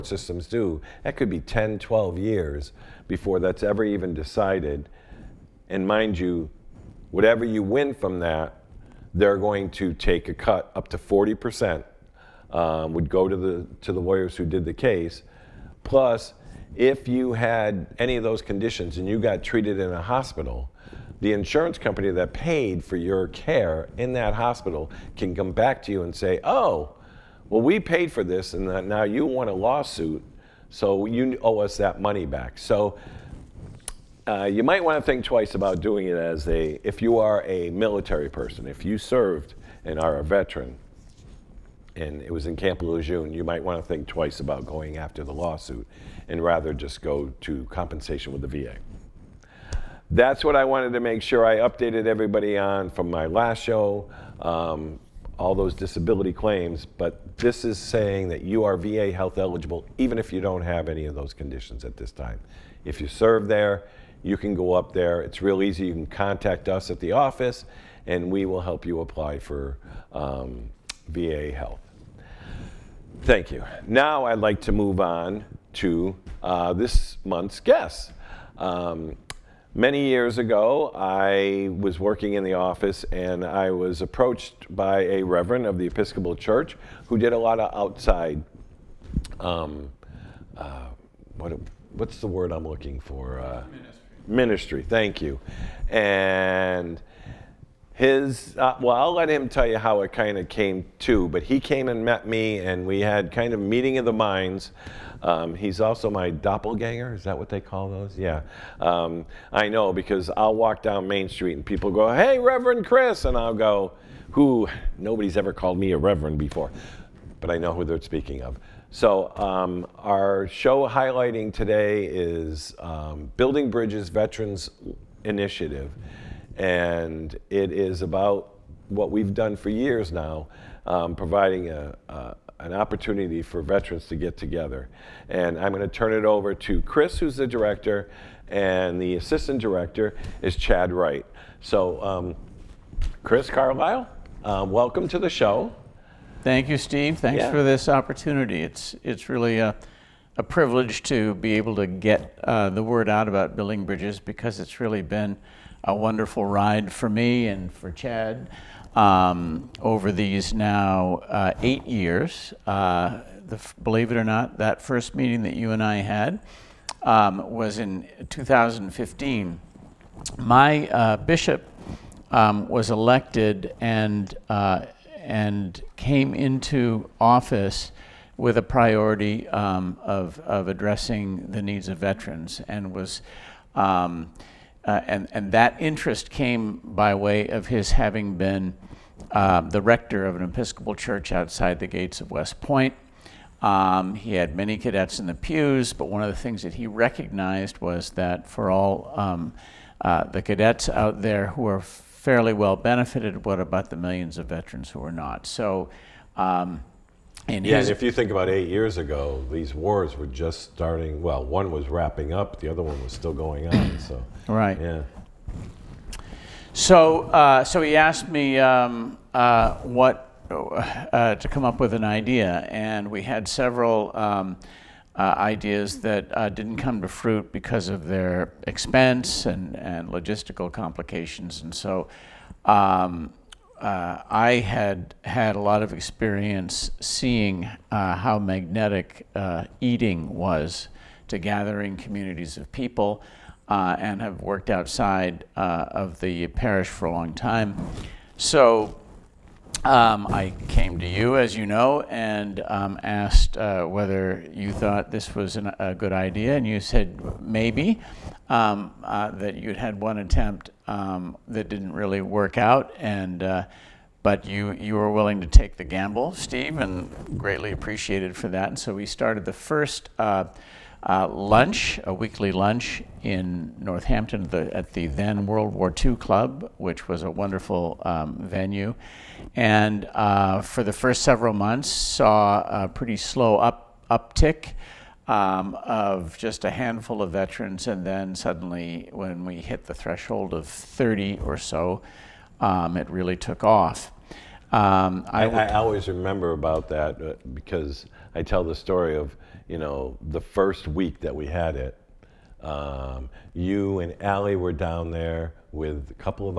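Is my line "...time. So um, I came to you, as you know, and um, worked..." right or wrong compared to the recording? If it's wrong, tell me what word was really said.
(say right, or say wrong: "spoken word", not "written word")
wrong: "asked", not "worked".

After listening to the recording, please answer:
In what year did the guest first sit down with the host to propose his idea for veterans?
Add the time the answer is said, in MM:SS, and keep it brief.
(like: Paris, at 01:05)
2015, at 02:48.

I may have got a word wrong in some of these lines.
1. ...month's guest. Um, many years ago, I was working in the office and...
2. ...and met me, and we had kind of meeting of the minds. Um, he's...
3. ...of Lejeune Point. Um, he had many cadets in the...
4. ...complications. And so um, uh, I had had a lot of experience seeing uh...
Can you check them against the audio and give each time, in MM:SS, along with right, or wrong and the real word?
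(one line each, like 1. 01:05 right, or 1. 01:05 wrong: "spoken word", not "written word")
1. 01:17 right
2. 01:41 right
3. 03:12 wrong: "West", not "Lejeune"
4. 03:50 right.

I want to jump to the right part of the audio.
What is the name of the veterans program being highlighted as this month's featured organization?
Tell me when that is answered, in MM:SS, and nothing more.
02:03.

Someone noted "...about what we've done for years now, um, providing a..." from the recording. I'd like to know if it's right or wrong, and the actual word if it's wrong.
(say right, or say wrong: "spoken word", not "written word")
right.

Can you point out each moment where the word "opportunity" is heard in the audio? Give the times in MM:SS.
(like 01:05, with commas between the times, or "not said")
02:12, 02:27.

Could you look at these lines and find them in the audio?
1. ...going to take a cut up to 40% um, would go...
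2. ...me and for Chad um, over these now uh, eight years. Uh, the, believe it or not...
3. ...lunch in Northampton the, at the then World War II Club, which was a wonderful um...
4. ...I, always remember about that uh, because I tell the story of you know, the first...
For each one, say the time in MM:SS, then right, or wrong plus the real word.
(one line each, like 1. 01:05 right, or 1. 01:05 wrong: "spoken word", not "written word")
1. 00:09 right
2. 02:37 right
3. 04:32 right
4. 04:55 right.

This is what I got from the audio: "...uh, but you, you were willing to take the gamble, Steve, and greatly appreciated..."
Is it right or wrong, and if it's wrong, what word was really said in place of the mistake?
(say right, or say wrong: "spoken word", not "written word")
right.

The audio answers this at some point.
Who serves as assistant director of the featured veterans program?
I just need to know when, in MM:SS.
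02:20.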